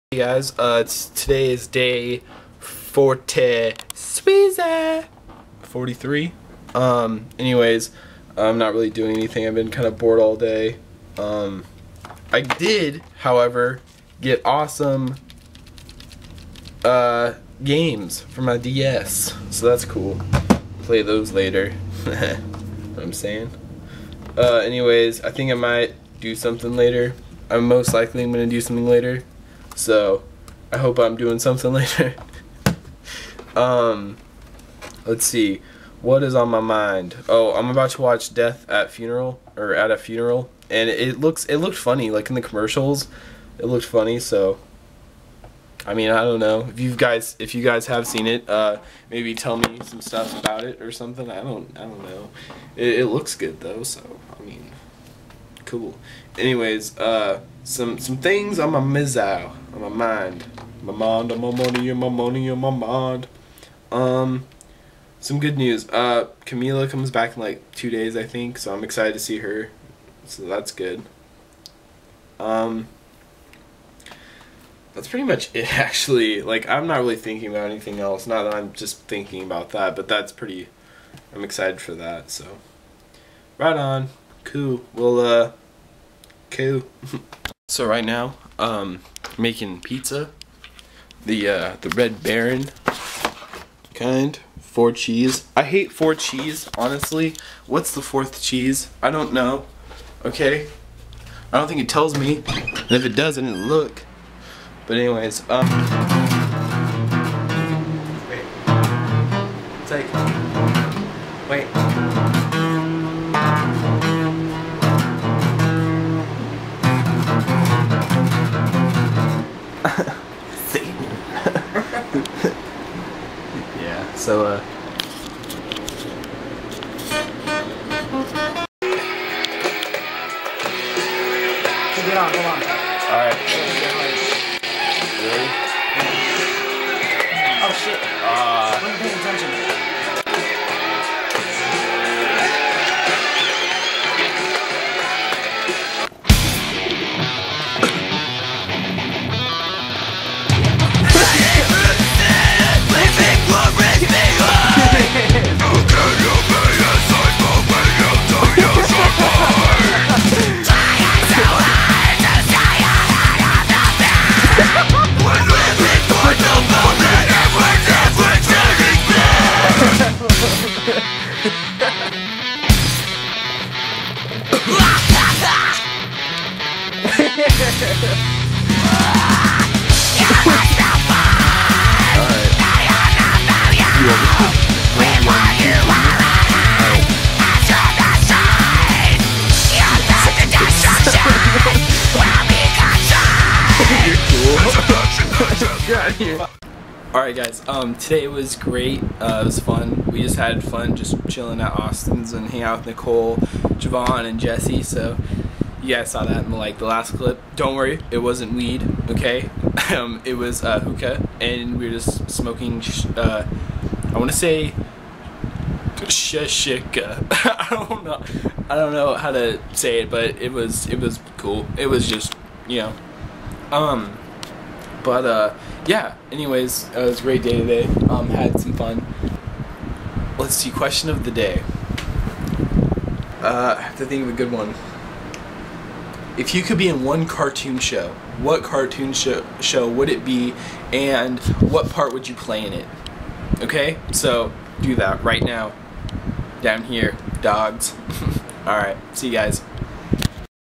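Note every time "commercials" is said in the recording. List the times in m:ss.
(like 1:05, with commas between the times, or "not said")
0:42.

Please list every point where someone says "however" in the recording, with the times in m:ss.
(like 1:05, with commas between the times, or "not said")
0:13.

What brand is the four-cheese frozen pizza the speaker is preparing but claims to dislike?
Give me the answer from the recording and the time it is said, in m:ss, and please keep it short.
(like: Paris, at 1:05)
Red Baron, at 1:31.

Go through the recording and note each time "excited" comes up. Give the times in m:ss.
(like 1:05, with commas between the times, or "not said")
1:08, 1:21.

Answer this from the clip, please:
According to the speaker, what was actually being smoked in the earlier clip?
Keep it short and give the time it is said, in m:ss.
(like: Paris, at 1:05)
Hookah, at 3:30.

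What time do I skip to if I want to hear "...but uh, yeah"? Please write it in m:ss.
3:45.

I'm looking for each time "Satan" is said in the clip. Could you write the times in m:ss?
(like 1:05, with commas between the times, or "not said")
1:59.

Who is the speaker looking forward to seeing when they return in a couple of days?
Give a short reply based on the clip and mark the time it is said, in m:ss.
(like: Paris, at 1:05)
Camila, at 1:06.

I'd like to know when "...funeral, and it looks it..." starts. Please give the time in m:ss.
0:39.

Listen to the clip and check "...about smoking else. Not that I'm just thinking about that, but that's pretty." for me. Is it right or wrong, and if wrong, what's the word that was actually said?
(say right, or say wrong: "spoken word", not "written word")
wrong: "anything", not "smoking".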